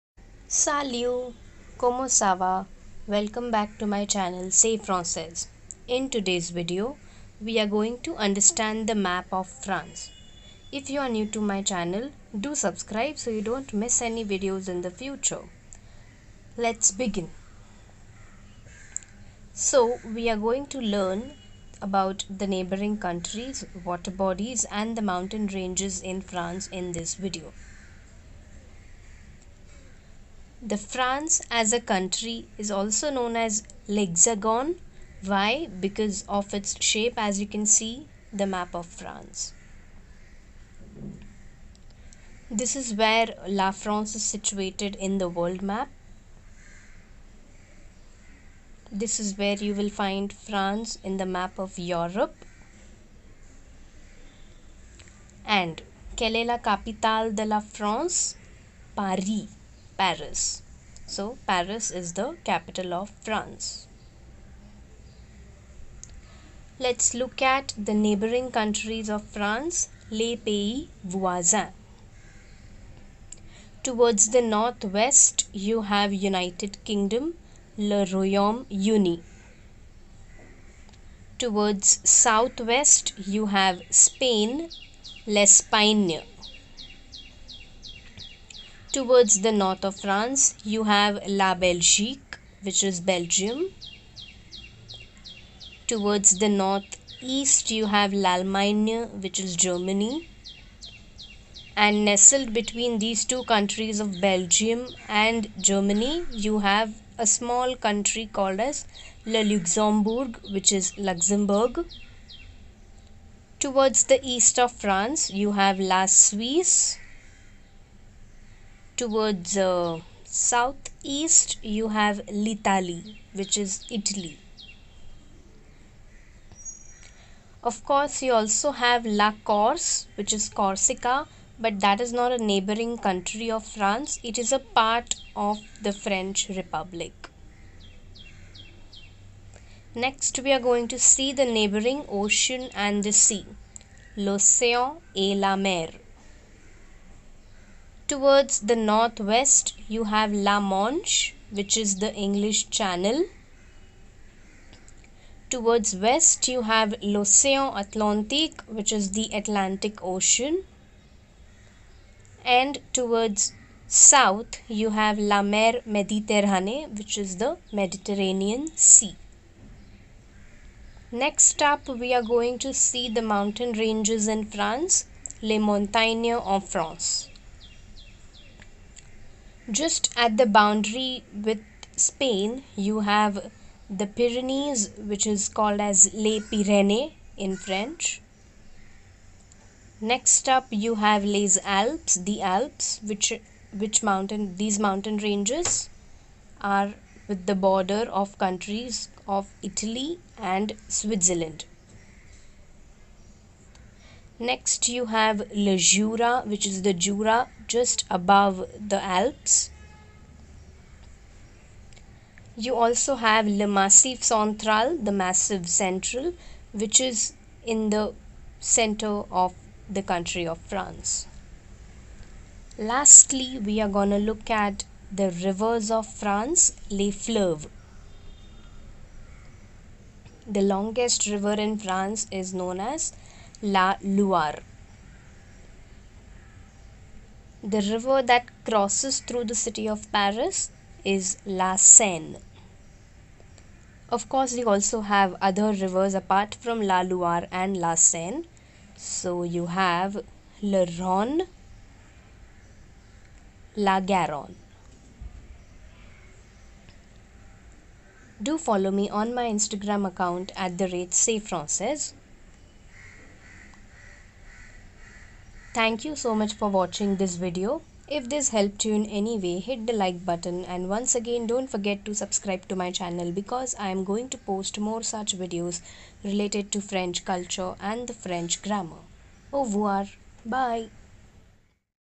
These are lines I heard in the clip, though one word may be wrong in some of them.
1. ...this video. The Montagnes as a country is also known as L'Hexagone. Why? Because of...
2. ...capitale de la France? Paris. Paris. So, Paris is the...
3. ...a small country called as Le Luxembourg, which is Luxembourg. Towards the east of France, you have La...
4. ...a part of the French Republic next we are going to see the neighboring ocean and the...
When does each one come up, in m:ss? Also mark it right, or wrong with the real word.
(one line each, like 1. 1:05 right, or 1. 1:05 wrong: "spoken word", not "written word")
1. 0:26 wrong: "France", not "Montagnes"
2. 0:56 right
3. 1:47 right
4. 2:14 right.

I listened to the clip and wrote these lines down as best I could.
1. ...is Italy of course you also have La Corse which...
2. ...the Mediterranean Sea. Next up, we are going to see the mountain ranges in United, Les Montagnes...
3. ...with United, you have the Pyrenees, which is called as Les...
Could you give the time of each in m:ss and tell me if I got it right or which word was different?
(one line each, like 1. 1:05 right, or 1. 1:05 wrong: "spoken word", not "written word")
1. 2:03 right
2. 2:47 wrong: "France", not "United"
3. 3:01 wrong: "Spain", not "United".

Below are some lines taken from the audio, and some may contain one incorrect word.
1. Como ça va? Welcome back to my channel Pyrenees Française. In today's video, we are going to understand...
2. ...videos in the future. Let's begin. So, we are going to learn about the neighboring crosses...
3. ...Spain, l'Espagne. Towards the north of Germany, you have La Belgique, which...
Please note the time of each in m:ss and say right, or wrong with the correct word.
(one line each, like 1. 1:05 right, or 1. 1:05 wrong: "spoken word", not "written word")
1. 0:01 wrong: "Say", not "Pyrenees"
2. 0:14 wrong: "countries", not "crosses"
3. 1:23 wrong: "France", not "Germany".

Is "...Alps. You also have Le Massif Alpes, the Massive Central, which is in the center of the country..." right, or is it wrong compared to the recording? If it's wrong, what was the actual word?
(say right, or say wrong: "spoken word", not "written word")
wrong: "Central", not "Alpes".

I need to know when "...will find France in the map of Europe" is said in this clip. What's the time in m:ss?
0:49.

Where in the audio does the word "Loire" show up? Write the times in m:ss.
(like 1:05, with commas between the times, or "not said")
3:54, 4:07.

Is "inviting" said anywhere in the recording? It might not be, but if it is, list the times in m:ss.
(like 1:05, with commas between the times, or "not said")
not said.